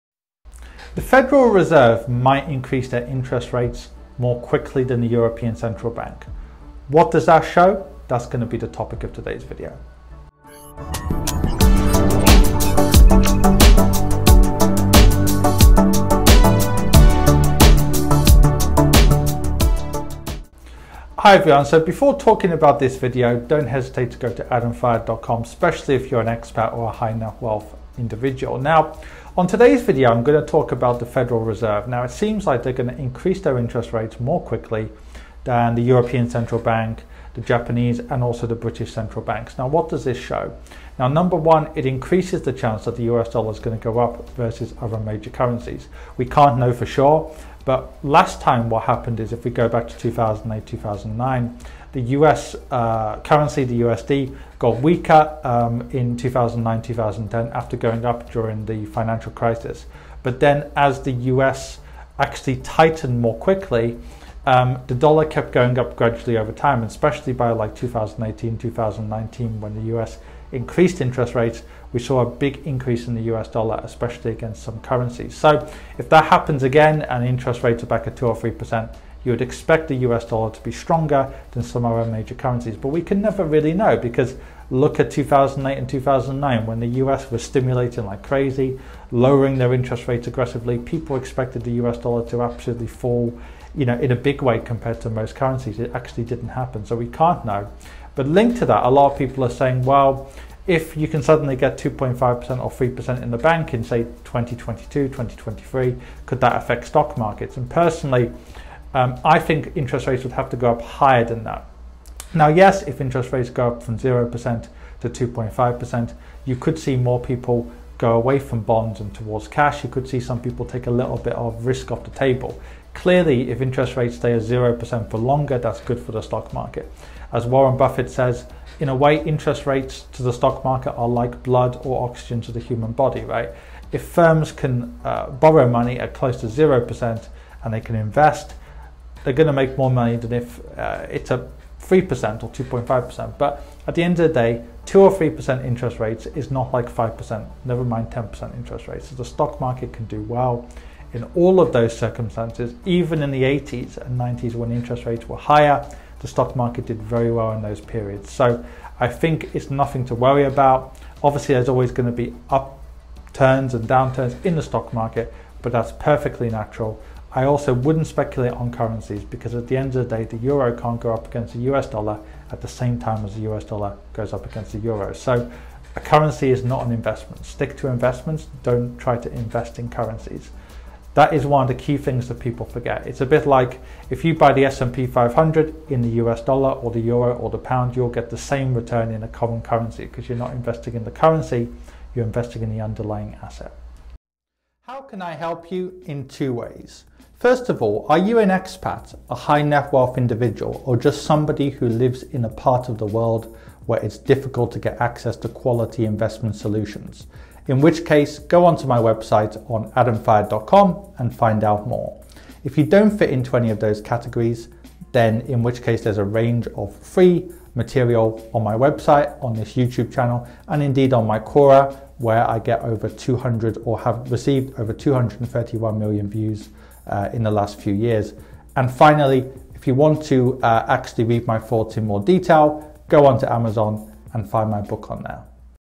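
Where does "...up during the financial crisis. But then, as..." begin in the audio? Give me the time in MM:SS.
00:58.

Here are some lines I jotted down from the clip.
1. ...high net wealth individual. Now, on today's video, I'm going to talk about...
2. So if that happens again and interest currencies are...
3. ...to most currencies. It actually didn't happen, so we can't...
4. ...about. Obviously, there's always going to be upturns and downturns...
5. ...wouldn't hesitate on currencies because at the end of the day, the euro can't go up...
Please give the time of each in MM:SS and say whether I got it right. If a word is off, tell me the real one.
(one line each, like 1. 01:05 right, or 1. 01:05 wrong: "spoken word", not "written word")
1. 00:26 right
2. 01:15 wrong: "rates", not "currencies"
3. 01:35 right
4. 02:40 right
5. 02:47 wrong: "speculate", not "hesitate".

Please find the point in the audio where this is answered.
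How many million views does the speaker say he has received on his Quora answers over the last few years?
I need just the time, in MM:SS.
03:44.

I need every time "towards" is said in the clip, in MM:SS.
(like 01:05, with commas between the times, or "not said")
01:59.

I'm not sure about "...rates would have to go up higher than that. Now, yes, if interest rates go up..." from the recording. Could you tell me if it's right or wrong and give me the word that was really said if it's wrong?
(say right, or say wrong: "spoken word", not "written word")
right.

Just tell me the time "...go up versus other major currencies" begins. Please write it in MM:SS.
00:43.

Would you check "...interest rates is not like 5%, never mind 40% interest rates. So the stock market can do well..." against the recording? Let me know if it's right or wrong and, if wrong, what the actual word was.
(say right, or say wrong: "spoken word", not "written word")
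wrong: "10", not "40".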